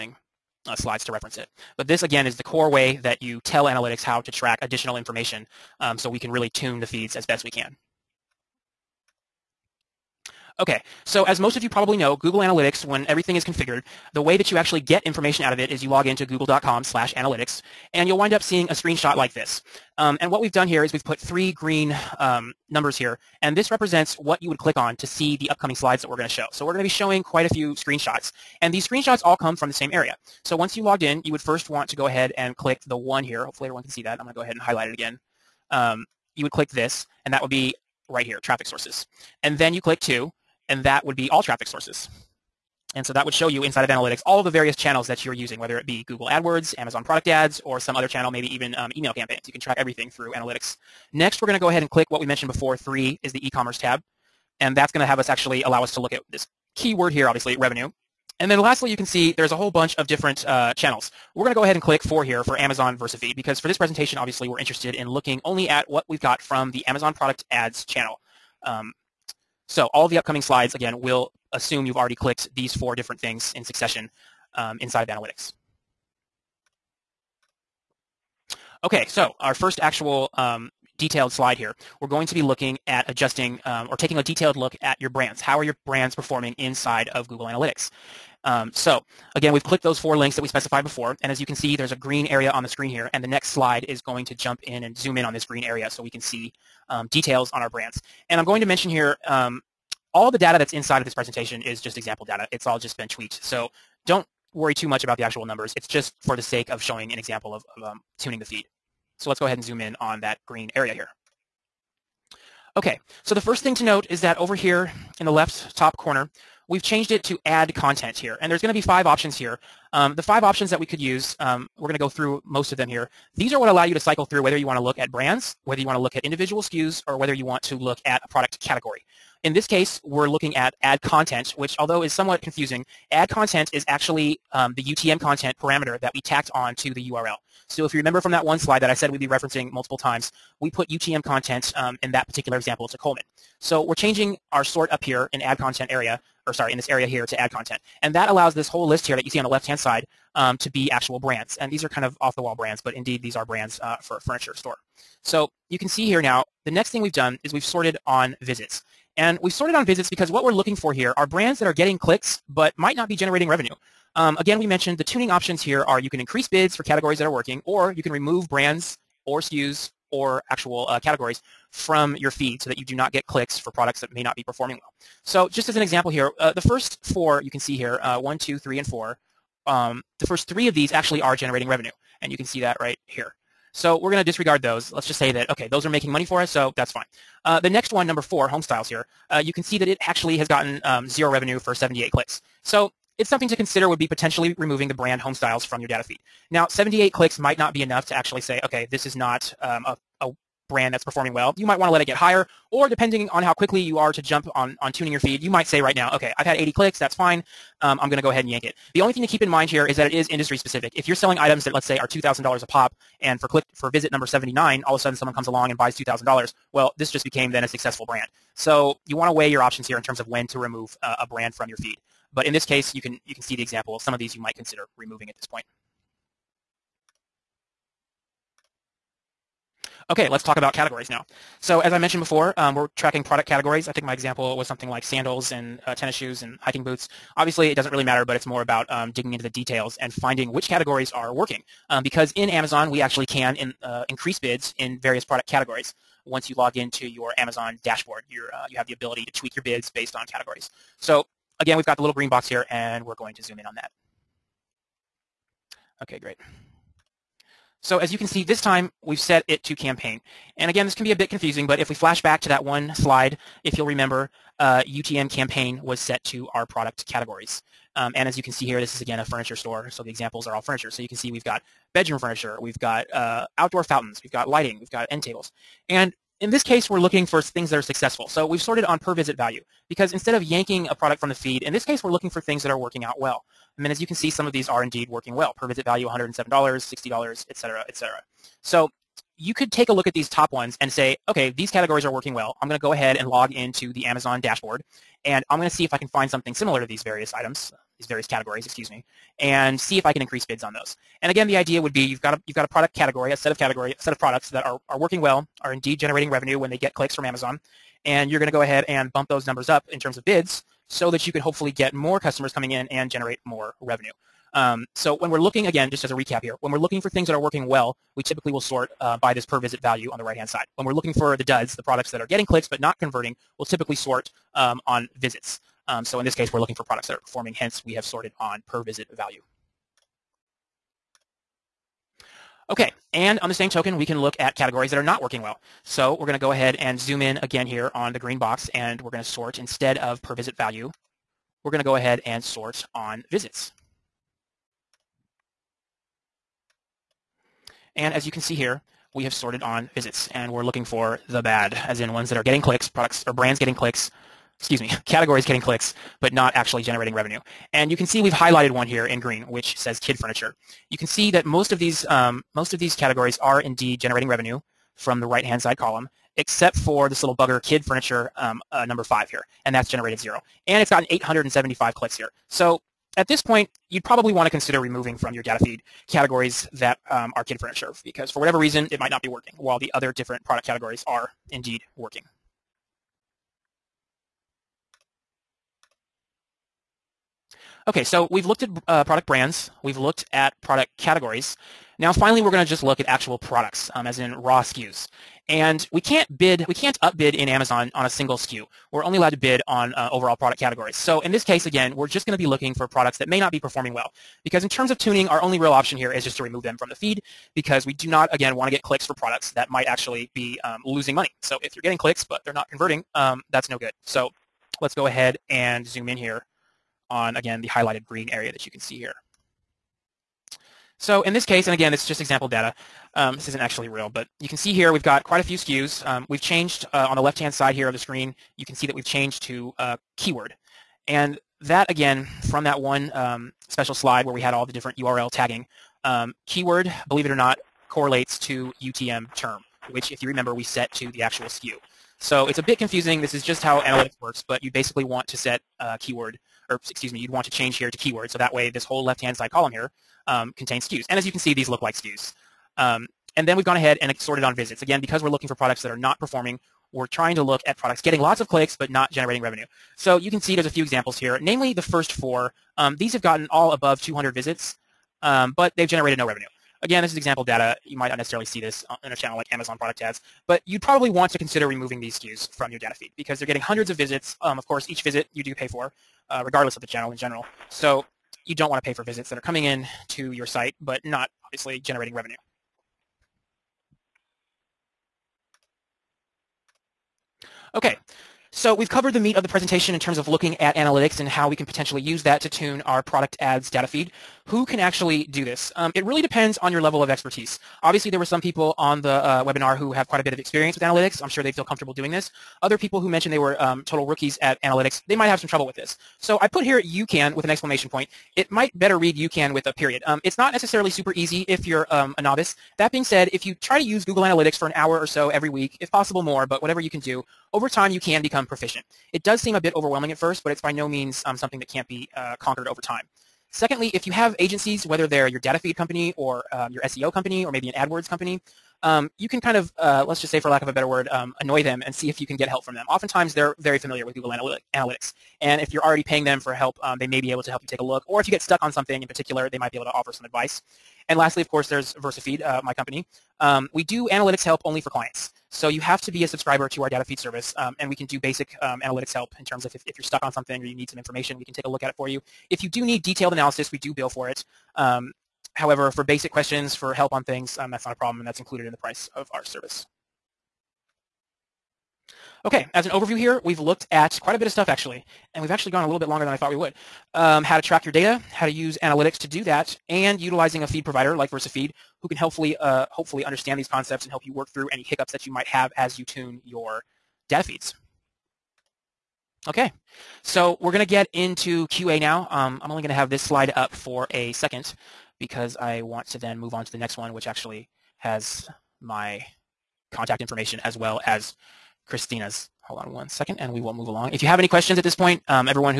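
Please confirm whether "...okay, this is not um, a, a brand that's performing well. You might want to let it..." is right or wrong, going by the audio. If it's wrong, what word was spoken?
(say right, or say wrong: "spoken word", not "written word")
right.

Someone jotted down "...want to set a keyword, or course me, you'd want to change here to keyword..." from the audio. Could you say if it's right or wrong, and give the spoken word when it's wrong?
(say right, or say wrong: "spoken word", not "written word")
wrong: "excuse", not "course".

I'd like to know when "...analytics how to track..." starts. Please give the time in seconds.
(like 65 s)
3 s.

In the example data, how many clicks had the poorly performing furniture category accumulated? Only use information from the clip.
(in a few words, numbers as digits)
875.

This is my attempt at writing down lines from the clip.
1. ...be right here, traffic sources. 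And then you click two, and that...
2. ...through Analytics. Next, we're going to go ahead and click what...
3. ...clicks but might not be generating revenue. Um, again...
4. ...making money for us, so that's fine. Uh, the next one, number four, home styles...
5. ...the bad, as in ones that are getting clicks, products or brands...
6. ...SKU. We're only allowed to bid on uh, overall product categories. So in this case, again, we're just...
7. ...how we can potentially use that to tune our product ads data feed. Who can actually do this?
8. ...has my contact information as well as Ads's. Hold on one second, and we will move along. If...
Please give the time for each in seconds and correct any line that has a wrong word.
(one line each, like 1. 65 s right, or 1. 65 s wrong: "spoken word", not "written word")
1. 37 s right
2. 50 s right
3. 161 s right
4. 185 s right
5. 351 s right
6. 398 s right
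7. 491 s right
8. 587 s wrong: "Christina", not "Ads".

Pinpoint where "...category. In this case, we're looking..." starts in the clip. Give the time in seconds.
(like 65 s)
128 s.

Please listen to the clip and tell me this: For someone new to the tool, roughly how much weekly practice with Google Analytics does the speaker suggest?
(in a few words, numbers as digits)
An hour.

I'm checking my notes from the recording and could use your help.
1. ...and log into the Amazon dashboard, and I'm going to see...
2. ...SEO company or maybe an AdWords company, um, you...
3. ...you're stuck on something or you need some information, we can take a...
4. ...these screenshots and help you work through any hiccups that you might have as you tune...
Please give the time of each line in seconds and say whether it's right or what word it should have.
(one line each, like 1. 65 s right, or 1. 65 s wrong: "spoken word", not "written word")
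1. 293 s right
2. 526 s right
3. 549 s right
4. 573 s wrong: "concepts", not "screenshots".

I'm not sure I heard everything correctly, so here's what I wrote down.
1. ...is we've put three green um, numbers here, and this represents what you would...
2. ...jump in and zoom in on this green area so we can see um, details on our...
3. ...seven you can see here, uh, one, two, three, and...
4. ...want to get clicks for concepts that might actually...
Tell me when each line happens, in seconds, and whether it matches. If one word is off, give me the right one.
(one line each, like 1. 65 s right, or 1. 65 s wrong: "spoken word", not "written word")
1. 20 s right
2. 94 s right
3. 177 s wrong: "four", not "seven"
4. 408 s wrong: "products", not "concepts".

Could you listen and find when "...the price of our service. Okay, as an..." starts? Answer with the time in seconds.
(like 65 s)
558 s.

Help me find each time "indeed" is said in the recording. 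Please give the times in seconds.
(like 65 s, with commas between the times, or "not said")
152 s, 284 s, 305 s, 363 s, 381 s.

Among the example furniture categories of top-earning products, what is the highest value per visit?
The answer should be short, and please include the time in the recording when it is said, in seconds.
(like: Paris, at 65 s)
$107, at 286 s.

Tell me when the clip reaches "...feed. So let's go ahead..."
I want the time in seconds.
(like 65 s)
108 s.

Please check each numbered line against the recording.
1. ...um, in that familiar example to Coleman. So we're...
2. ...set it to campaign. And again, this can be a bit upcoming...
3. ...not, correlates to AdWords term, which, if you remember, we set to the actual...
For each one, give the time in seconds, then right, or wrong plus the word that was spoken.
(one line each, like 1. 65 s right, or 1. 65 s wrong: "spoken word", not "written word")
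1. 141 s wrong: "particular", not "familiar"
2. 259 s wrong: "confusing", not "upcoming"
3. 437 s wrong: "UTM", not "AdWords".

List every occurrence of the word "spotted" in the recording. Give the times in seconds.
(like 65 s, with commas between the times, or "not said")
not said.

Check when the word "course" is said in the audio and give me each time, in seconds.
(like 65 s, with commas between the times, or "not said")
474 s, 541 s.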